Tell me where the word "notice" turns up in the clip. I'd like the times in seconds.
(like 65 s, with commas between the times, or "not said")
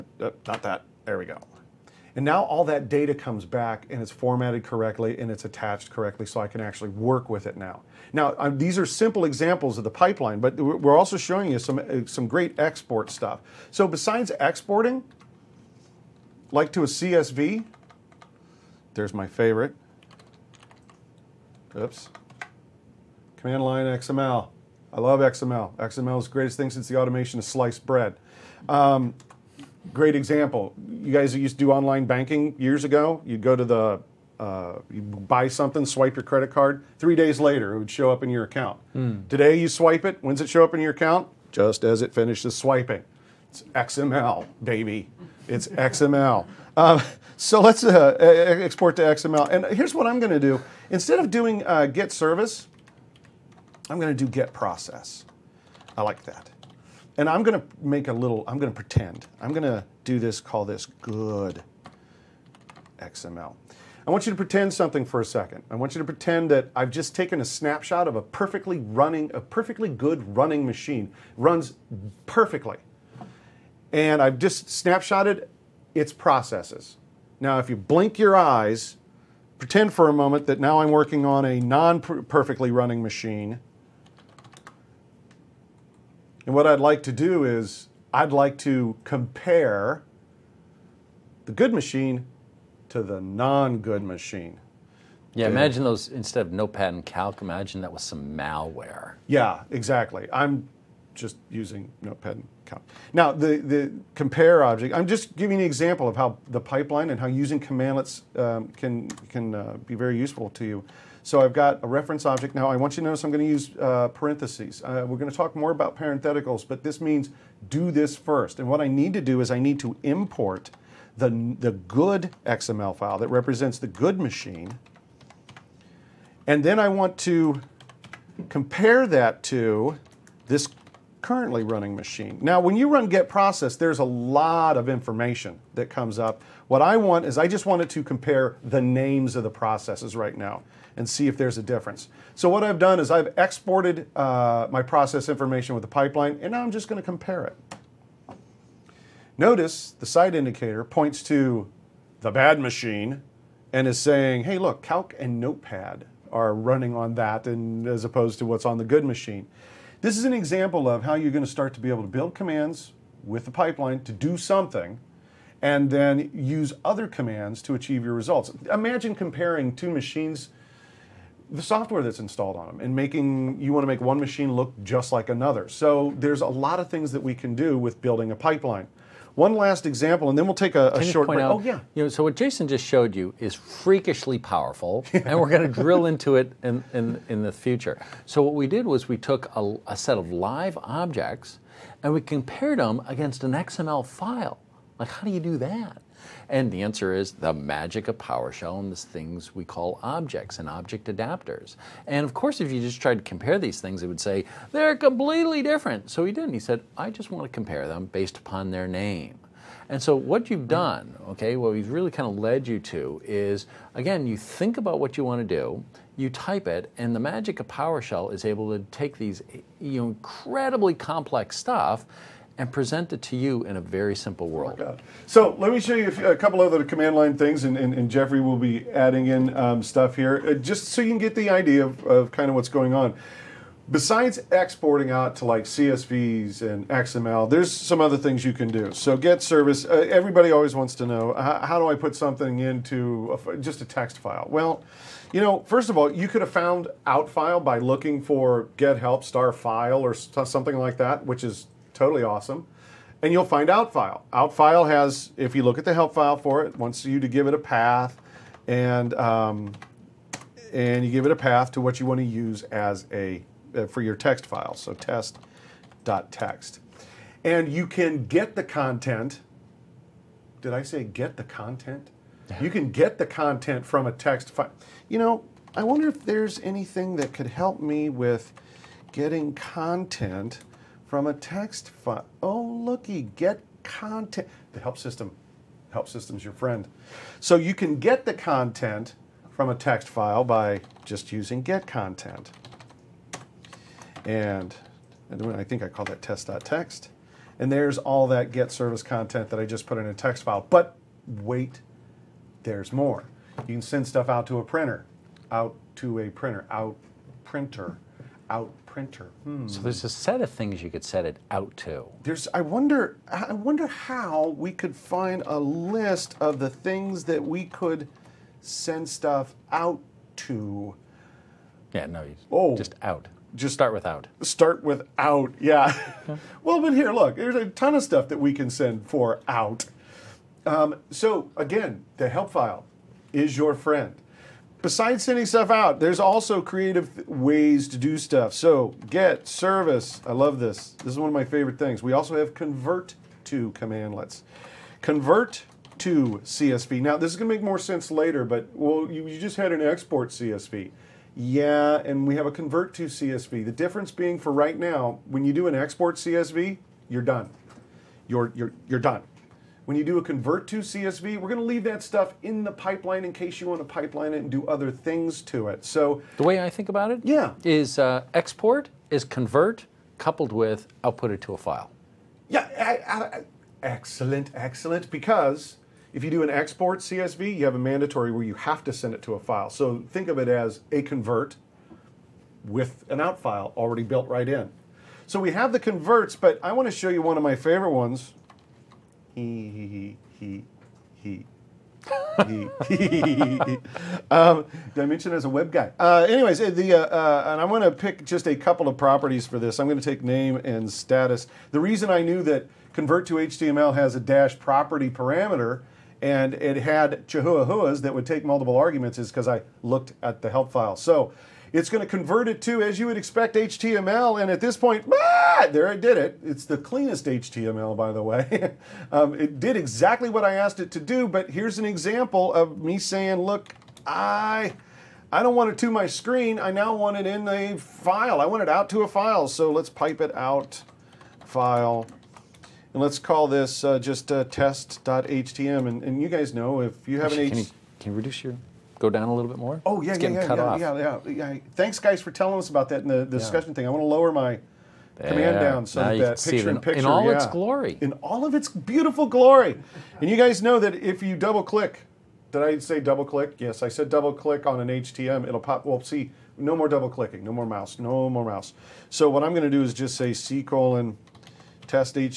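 113 s, 149 s.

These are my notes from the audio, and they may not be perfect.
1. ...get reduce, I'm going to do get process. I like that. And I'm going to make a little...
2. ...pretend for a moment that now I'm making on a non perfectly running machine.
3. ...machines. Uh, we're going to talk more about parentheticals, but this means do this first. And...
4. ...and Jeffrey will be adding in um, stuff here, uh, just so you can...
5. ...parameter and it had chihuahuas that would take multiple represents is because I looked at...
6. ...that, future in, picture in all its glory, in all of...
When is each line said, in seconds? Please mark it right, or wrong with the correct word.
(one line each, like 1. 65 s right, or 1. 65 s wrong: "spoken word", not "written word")
1. 51 s wrong: "service", not "reduce"
2. 79 s wrong: "working", not "making"
3. 114 s wrong: "parentheses", not "machines"
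4. 227 s right
5. 405 s wrong: "arguments", not "represents"
6. 446 s wrong: "picture", not "future".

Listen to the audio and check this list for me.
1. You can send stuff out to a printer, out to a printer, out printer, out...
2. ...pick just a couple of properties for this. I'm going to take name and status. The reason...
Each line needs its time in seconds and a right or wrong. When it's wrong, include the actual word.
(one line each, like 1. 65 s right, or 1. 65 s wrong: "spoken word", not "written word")
1. 303 s right
2. 397 s right.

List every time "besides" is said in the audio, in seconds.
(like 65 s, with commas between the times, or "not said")
13 s, 233 s, 334 s.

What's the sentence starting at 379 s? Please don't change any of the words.
So think of it as a convert with an out file already built right in.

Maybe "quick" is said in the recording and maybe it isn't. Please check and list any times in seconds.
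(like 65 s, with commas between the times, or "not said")
not said.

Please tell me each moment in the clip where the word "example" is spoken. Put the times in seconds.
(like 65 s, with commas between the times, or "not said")
9 s, 30 s, 105 s, 160 s, 179 s, 421 s.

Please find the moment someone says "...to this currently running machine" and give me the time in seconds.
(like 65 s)
129 s.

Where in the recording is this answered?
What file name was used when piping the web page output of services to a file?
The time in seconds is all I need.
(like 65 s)
434 s.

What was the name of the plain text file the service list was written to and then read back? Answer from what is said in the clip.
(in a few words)
test.txt.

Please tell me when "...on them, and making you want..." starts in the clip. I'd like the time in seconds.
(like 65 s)
172 s.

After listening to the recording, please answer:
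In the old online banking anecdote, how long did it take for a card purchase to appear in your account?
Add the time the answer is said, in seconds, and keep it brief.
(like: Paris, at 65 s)
3 days, at 36 s.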